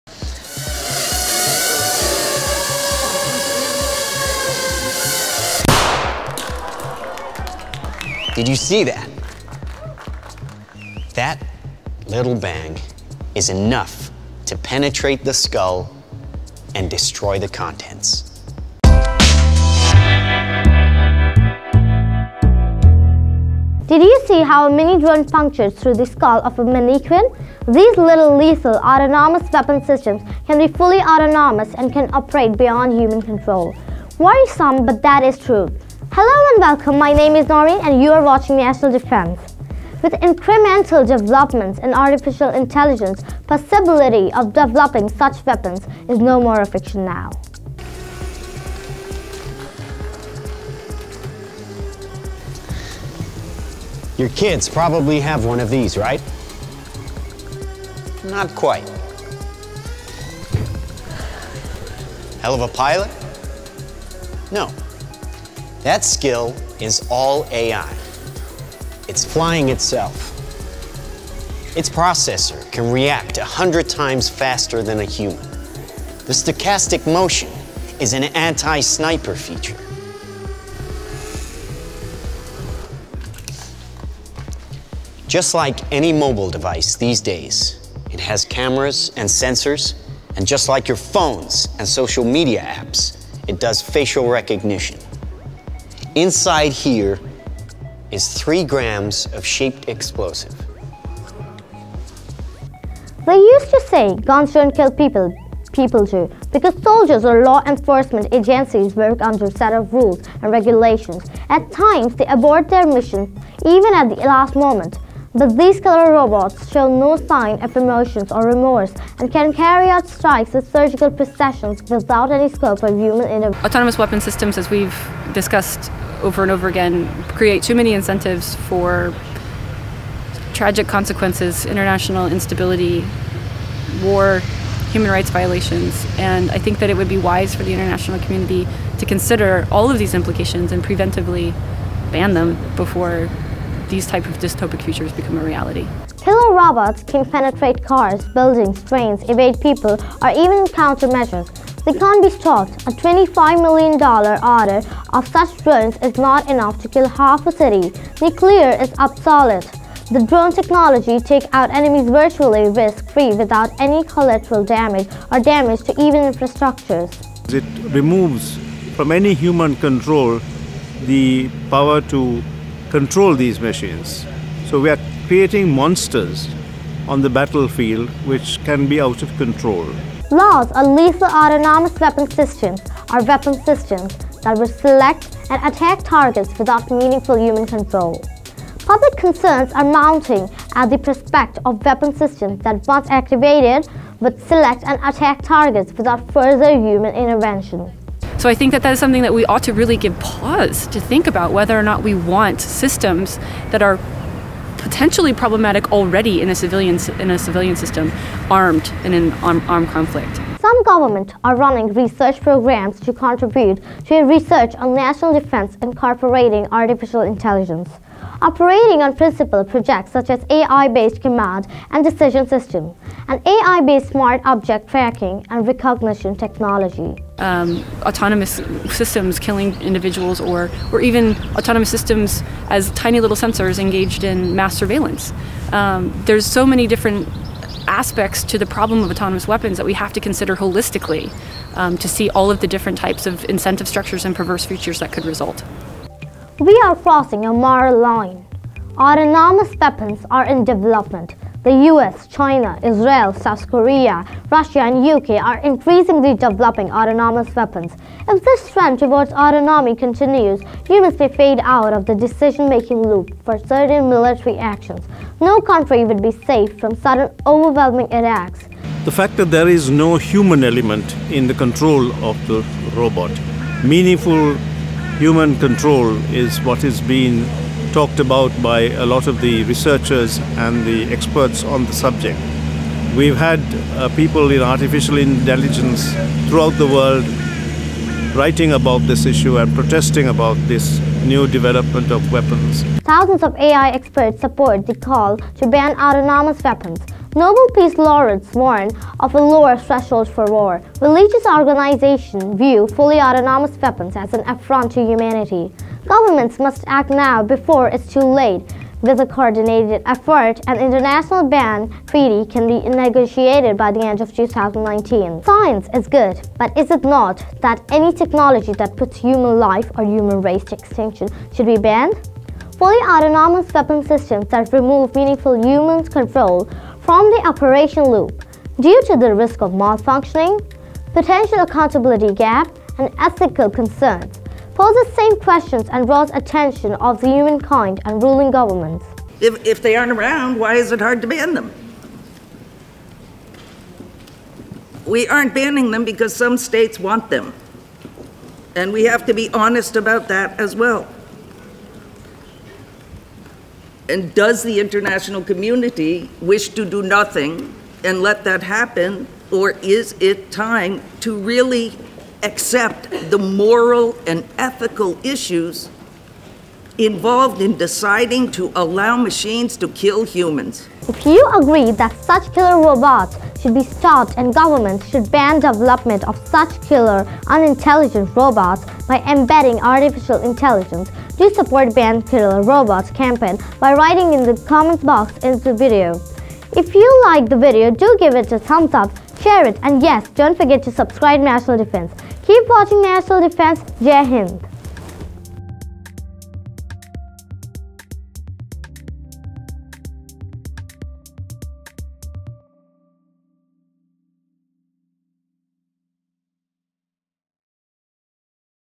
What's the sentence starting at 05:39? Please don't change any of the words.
If, if they aren't around, why is it hard to ban them?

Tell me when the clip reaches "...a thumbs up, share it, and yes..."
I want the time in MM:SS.
06:28.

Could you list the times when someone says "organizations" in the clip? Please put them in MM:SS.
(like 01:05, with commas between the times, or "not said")
05:01.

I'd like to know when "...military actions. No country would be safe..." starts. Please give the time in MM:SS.
04:24.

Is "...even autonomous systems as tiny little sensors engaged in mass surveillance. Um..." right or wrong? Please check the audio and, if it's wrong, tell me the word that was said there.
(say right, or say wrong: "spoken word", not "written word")
right.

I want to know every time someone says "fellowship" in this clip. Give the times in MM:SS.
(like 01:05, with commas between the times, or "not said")
not said.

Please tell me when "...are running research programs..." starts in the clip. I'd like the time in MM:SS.
03:31.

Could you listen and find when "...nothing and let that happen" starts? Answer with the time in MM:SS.
05:57.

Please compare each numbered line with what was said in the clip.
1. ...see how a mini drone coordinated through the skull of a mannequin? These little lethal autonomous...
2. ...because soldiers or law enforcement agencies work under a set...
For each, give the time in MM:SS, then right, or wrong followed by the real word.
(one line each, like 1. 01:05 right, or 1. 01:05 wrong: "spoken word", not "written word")
1. 00:24 wrong: "punctured", not "coordinated"
2. 01:46 right.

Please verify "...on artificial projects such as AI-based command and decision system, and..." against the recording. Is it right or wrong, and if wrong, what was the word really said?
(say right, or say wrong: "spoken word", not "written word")
wrong: "principal", not "artificial".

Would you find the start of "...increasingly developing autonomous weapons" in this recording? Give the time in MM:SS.
04:15.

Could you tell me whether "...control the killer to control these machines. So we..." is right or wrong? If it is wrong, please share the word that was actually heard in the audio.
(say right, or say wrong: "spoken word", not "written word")
wrong: "power", not "killer".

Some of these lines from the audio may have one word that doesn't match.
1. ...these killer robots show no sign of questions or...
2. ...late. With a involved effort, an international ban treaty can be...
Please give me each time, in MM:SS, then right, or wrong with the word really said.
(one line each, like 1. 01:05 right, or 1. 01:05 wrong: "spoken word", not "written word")
1. 01:55 wrong: "emotions", not "questions"
2. 05:08 wrong: "coordinated", not "involved".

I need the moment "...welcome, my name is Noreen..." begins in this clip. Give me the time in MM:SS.
00:36.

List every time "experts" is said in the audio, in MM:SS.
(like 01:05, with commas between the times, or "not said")
04:41, 04:53.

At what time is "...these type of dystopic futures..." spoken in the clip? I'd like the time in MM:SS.
02:23.